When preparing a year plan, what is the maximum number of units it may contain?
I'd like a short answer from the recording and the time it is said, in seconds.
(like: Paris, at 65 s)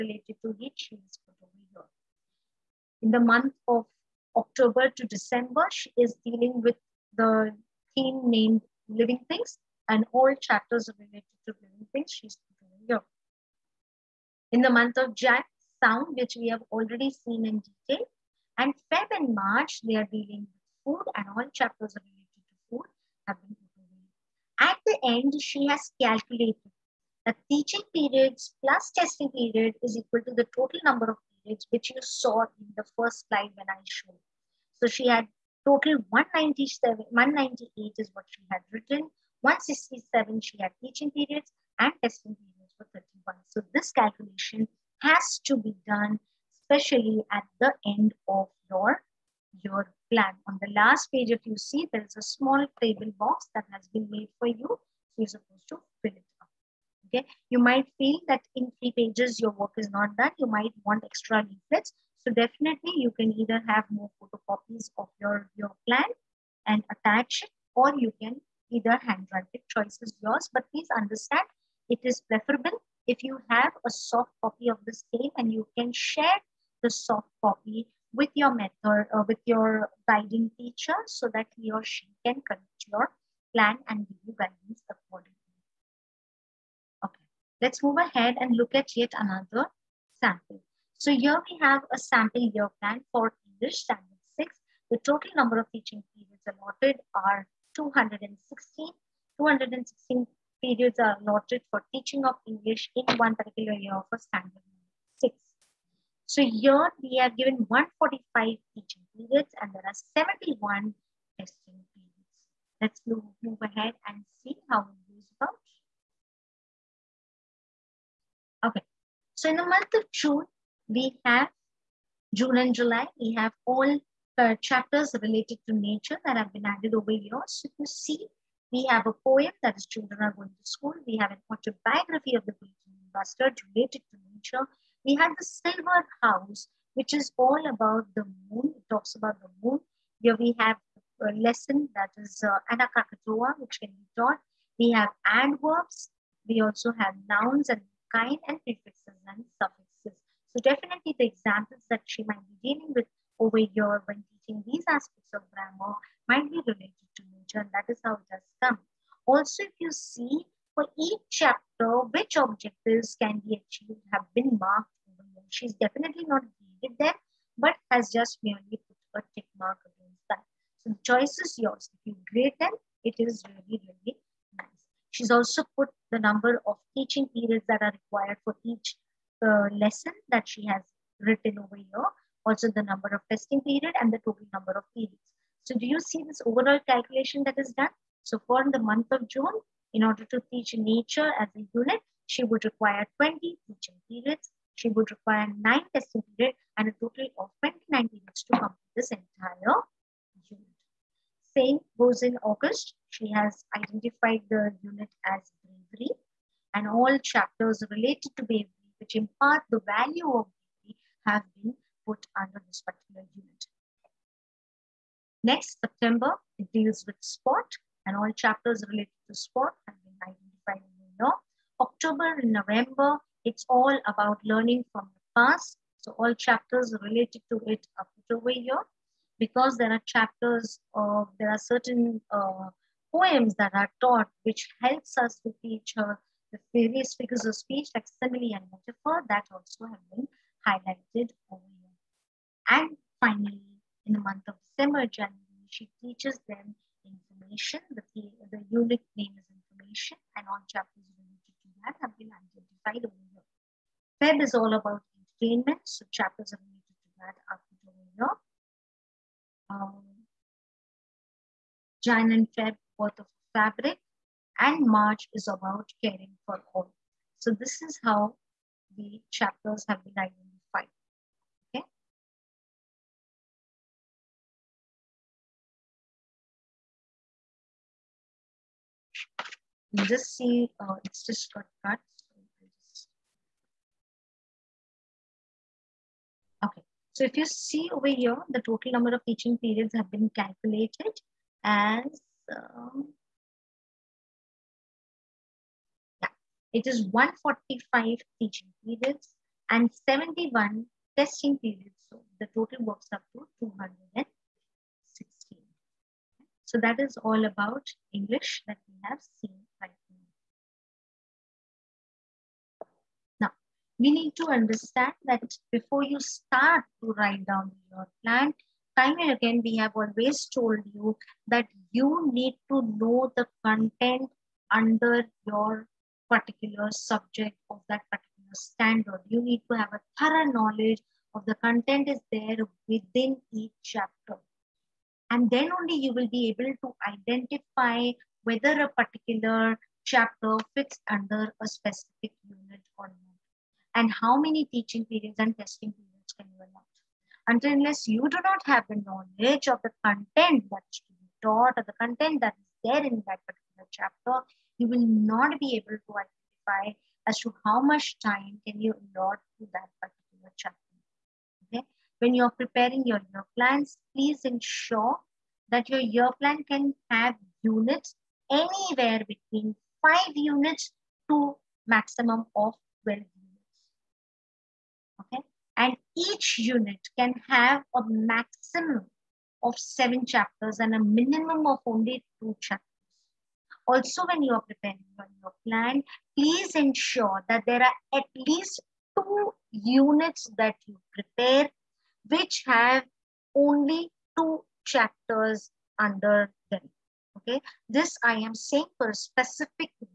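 12, at 373 s.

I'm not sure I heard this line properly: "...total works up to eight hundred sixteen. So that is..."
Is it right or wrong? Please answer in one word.
wrong.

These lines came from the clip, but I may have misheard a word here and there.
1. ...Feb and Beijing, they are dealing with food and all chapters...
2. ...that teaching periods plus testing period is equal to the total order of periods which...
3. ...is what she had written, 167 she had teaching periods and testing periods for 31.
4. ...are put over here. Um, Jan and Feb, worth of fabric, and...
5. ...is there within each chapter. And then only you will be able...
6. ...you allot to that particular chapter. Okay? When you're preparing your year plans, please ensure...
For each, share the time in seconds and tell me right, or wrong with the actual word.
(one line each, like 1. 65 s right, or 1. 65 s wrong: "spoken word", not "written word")
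1. 18 s wrong: "March", not "Beijing"
2. 27 s wrong: "number", not "order"
3. 37 s right
4. 257 s right
5. 332 s right
6. 358 s right.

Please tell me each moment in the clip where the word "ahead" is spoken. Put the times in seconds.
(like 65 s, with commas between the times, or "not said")
87 s, 113 s.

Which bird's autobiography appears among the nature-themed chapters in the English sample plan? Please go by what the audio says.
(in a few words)
Beijing Bustard.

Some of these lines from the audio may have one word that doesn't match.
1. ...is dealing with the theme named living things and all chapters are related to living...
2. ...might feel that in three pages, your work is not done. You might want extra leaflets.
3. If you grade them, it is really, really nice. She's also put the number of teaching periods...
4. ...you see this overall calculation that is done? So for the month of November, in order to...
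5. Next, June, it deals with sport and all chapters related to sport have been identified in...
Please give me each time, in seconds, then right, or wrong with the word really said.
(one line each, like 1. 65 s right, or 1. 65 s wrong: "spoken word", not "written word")
1. 5 s right
2. 57 s right
3. 171 s right
4. 185 s wrong: "June", not "November"
5. 215 s wrong: "September", not "June".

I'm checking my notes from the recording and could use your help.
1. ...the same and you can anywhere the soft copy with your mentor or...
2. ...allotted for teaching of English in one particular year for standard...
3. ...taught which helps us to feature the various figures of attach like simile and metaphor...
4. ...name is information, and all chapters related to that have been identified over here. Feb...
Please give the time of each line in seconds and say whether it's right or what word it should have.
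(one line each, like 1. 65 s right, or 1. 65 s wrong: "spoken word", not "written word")
1. 74 s wrong: "share", not "anywhere"
2. 101 s right
3. 234 s wrong: "speech", not "attach"
4. 249 s right.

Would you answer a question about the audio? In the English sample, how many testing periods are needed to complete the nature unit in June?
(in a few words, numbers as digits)
9.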